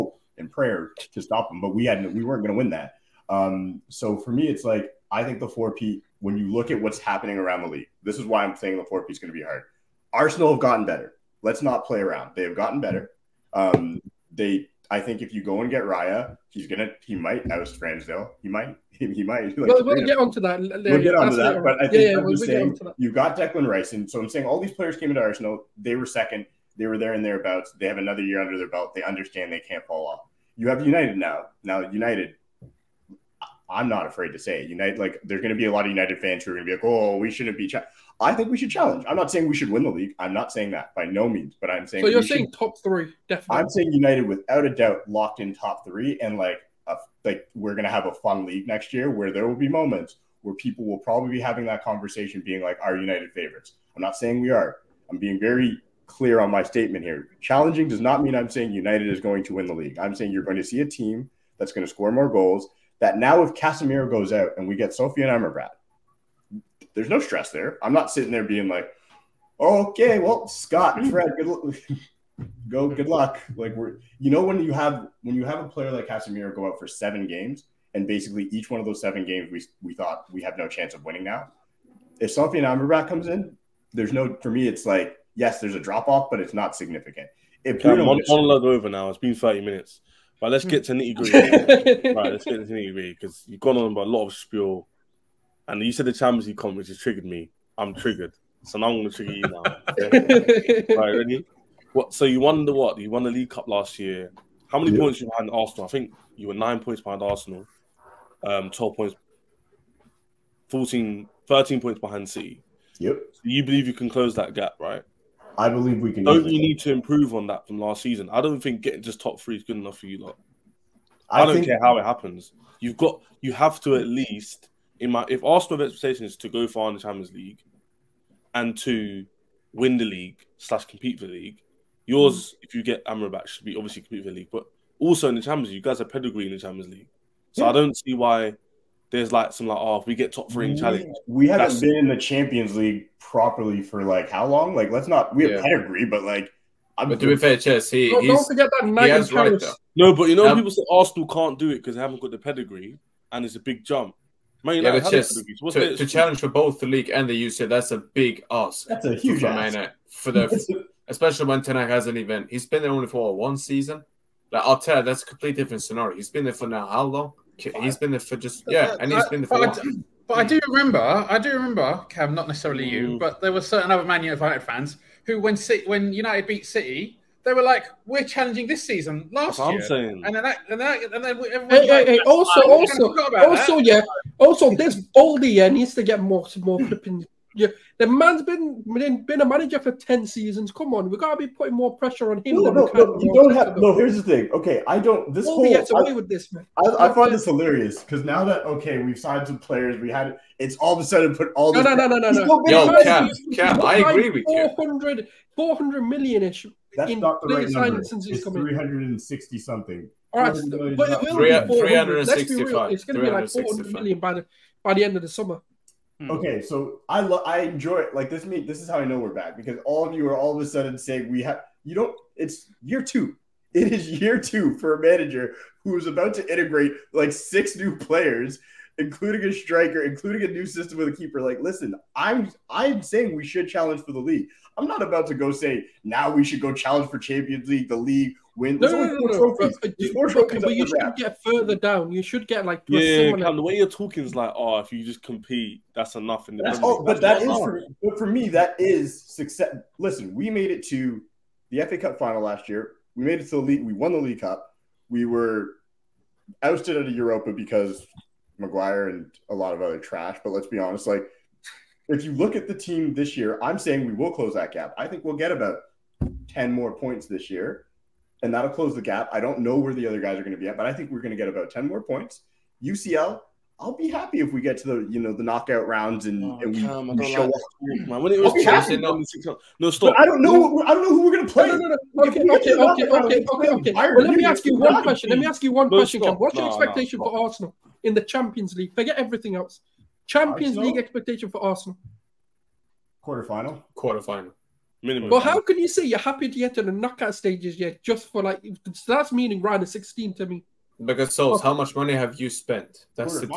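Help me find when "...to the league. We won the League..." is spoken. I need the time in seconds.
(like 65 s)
253 s.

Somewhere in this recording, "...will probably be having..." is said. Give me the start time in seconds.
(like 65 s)
50 s.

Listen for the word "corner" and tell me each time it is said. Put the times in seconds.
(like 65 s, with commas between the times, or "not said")
not said.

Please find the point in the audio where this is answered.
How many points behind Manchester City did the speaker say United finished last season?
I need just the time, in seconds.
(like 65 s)
111 s.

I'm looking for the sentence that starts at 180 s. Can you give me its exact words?
and then that, and, that, and then everyone hey, like, hey, hey, also, fine.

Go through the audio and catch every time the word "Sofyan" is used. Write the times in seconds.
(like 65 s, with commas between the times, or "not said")
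64 s, 82 s.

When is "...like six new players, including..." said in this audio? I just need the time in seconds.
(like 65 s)
227 s.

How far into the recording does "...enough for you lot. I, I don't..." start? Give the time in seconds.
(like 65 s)
119 s.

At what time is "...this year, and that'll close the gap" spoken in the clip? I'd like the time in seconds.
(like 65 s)
267 s.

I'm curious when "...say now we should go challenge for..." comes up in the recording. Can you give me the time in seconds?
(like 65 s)
235 s.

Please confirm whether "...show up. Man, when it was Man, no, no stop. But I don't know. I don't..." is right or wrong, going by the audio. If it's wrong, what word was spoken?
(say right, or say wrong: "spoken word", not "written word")
wrong: "Chelsea", not "Man".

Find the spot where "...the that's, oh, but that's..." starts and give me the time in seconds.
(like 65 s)
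246 s.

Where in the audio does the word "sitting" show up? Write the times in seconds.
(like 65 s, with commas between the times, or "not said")
68 s.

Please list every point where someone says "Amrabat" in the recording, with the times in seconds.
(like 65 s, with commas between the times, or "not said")
65 s, 82 s, 133 s.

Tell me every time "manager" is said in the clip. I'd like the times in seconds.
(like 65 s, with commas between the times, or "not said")
189 s, 225 s.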